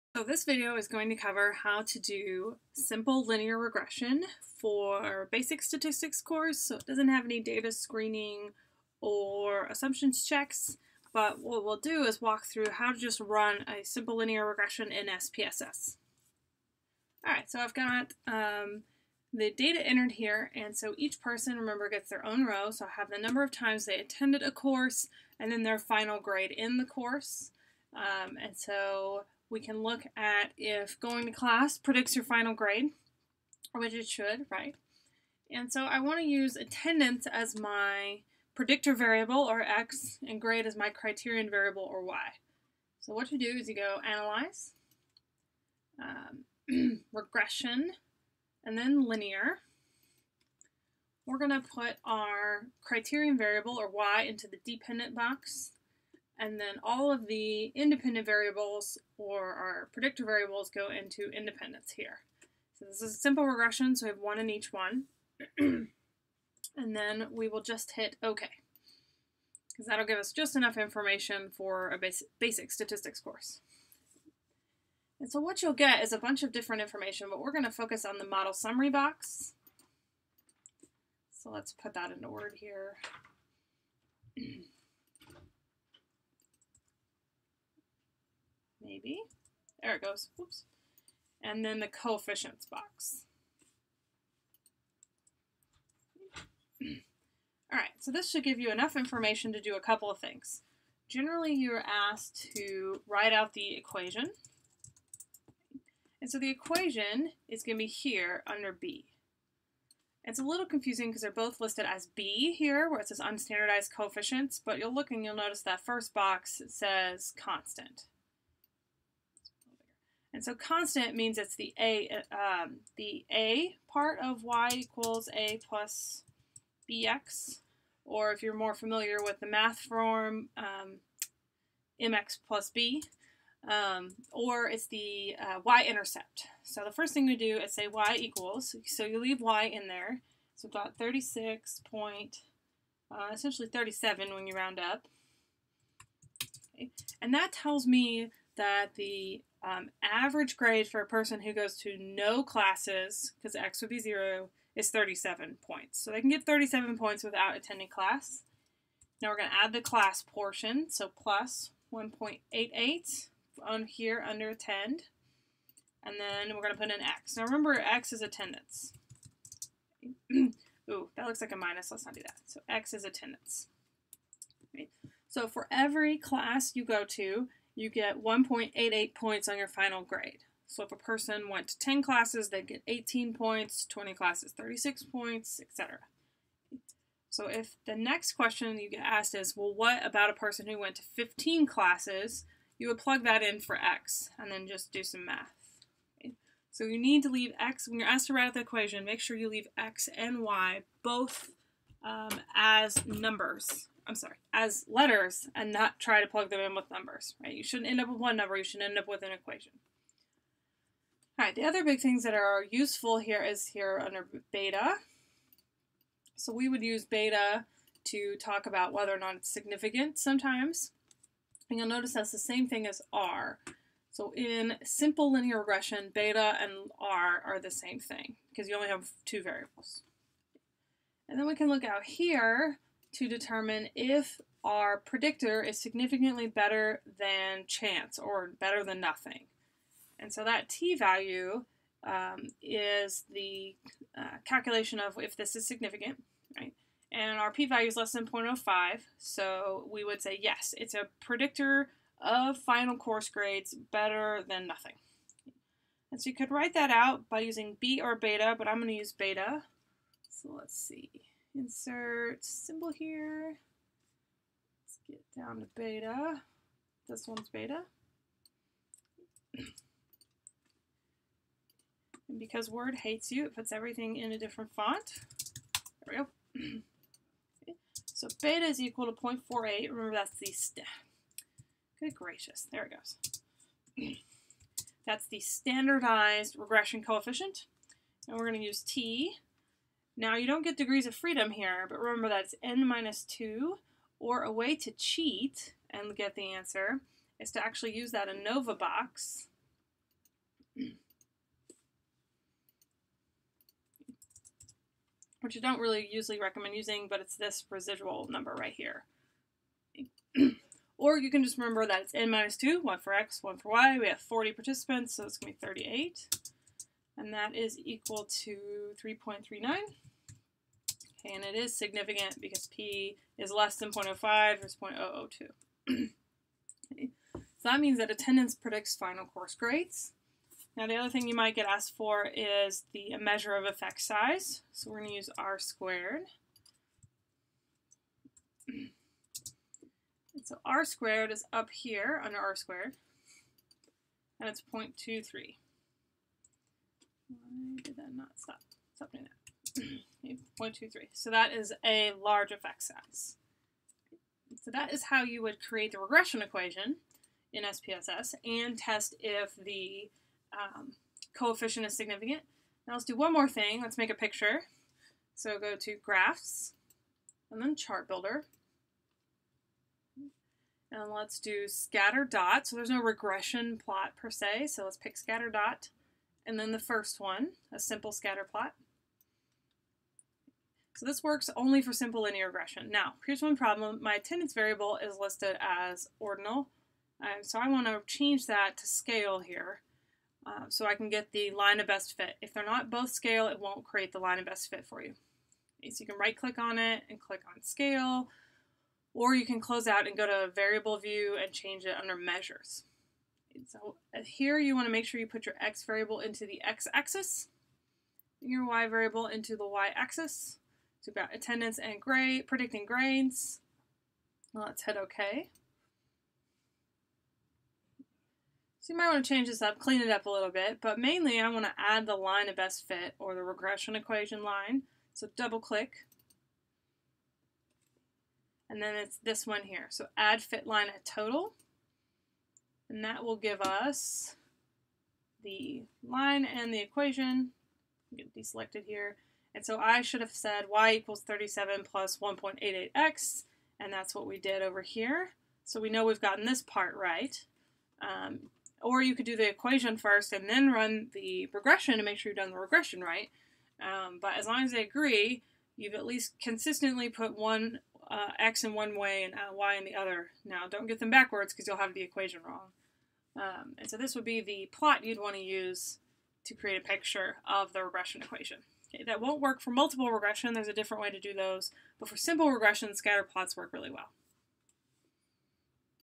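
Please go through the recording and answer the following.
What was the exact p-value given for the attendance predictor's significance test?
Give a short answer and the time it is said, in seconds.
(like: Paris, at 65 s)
0.002, at 324 s.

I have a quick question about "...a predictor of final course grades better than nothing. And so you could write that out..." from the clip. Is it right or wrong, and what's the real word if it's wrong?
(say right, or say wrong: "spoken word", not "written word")
right.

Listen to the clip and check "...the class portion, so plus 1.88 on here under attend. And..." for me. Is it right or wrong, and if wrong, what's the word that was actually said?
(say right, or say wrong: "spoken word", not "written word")
right.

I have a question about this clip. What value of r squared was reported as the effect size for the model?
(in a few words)
0.23.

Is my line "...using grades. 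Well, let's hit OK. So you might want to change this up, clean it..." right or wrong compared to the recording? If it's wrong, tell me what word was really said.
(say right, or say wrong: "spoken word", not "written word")
wrong: "predicting", not "using".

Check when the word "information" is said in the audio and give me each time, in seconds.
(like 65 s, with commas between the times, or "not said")
70 s, 76 s, 98 s.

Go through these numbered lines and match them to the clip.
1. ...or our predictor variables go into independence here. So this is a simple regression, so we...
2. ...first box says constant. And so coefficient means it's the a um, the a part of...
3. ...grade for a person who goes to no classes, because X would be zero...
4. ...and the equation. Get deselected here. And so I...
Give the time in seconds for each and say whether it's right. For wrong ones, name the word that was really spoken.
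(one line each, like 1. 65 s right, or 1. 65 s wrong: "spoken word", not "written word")
1. 59 s right
2. 115 s wrong: "constant", not "coefficient"
3. 150 s right
4. 436 s right.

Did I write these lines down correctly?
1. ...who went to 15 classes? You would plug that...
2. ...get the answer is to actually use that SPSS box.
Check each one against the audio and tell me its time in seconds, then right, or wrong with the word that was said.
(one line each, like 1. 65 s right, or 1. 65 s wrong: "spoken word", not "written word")
1. 190 s right
2. 296 s wrong: "ANOVA", not "SPSS".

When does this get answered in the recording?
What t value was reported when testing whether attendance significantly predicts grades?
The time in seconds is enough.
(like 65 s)
319 s.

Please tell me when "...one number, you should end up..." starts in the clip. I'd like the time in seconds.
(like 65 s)
208 s.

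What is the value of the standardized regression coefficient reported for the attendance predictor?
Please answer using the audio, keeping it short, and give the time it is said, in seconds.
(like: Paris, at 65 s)
0.48, at 279 s.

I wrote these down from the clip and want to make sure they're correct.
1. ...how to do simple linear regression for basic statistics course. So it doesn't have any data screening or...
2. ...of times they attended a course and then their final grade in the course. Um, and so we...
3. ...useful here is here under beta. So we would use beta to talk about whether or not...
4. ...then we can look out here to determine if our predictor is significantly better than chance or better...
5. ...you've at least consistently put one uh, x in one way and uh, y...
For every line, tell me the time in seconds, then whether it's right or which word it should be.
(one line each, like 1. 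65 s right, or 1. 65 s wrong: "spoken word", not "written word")
1. 1 s right
2. 23 s right
3. 212 s right
4. 231 s right
5. 455 s right.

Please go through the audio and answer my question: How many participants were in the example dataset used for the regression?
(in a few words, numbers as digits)
40.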